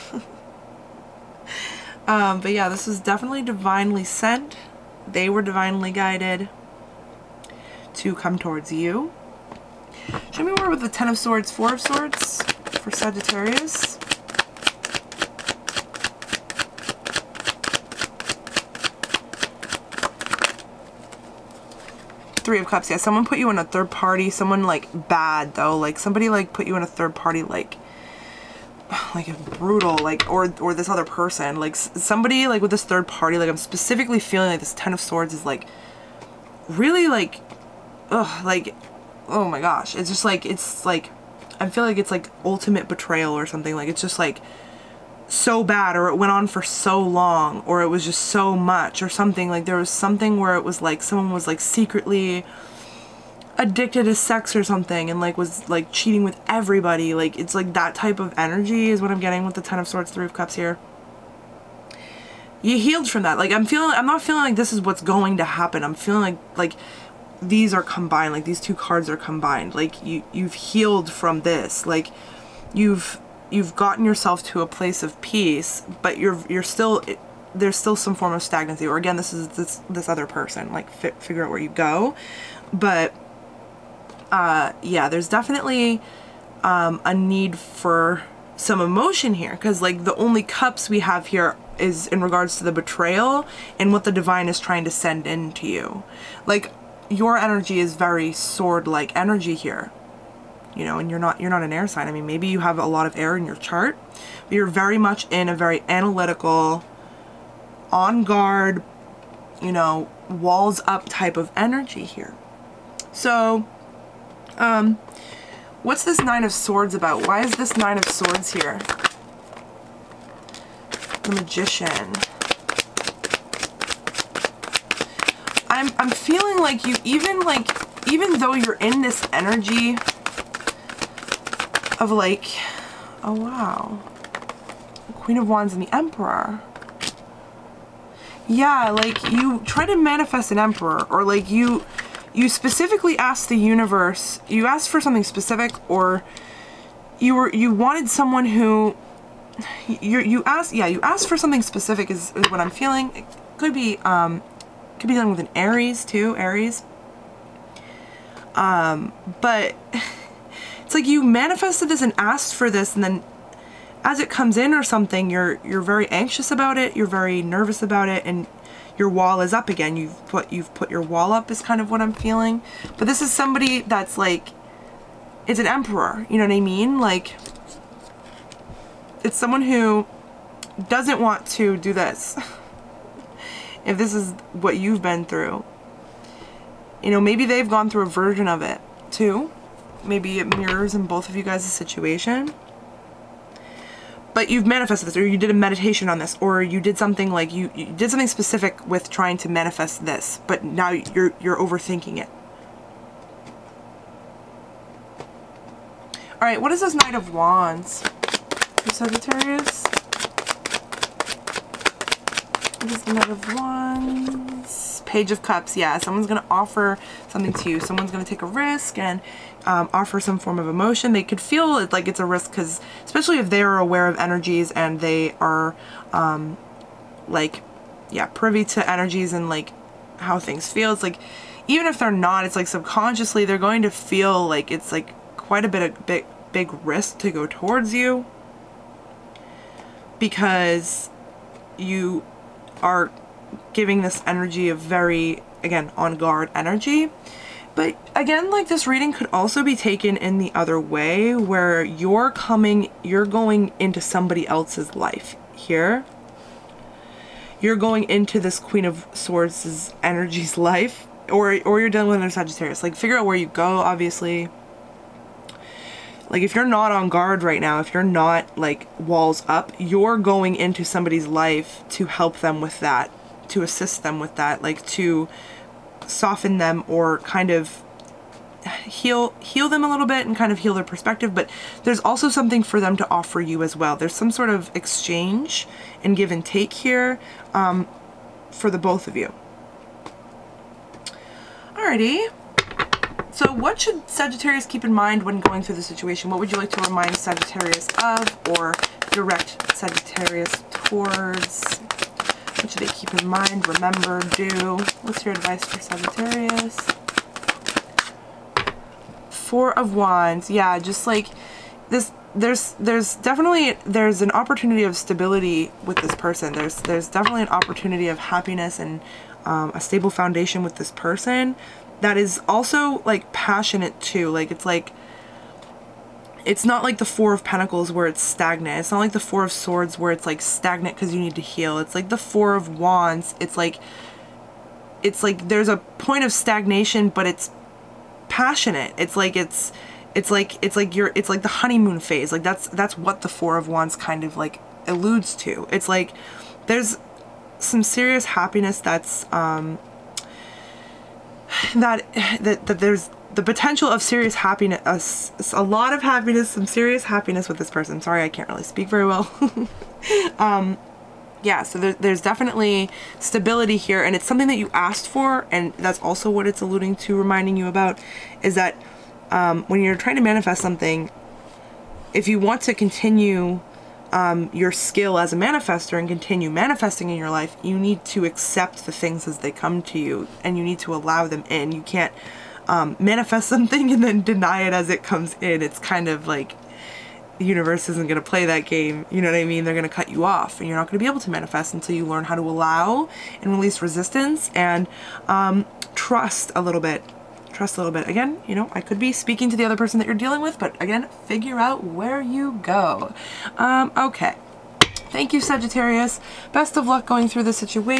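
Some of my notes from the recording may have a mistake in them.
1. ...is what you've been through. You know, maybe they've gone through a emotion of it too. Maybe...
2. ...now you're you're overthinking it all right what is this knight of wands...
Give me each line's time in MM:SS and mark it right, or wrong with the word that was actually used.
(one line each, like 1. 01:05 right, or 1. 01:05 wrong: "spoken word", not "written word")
1. 03:04 wrong: "version", not "emotion"
2. 03:20 right.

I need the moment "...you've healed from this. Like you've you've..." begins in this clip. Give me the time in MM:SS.
01:10.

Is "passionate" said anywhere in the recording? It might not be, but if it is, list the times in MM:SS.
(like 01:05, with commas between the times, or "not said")
05:23, 05:38.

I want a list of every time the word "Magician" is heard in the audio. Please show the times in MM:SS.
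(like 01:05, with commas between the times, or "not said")
02:01.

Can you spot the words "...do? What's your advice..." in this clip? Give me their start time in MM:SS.
05:04.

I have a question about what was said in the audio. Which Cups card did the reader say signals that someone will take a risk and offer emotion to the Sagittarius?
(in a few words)
Page of Cups.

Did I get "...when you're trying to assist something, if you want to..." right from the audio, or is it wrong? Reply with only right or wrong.
wrong.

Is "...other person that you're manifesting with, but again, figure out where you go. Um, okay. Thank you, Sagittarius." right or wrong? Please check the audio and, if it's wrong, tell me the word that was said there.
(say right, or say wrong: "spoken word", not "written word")
wrong: "dealing", not "manifesting".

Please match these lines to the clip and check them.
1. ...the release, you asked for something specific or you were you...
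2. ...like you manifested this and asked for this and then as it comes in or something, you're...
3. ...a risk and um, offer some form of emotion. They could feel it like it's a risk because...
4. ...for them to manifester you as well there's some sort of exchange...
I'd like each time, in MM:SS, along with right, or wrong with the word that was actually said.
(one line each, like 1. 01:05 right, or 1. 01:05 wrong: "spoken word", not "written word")
1. 02:23 wrong: "universe", not "release"
2. 02:40 right
3. 03:38 right
4. 04:42 wrong: "offer", not "manifester".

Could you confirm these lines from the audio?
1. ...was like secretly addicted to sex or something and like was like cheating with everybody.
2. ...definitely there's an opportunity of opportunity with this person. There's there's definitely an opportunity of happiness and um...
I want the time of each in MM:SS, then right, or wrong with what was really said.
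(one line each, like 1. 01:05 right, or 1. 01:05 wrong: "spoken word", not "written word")
1. 00:51 right
2. 05:13 wrong: "stability", not "opportunity".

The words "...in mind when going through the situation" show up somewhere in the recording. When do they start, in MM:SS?
04:54.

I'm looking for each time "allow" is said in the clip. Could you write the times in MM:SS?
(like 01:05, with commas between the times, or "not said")
06:20, 06:32.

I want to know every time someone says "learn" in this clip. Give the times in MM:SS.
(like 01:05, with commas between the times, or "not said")
06:32.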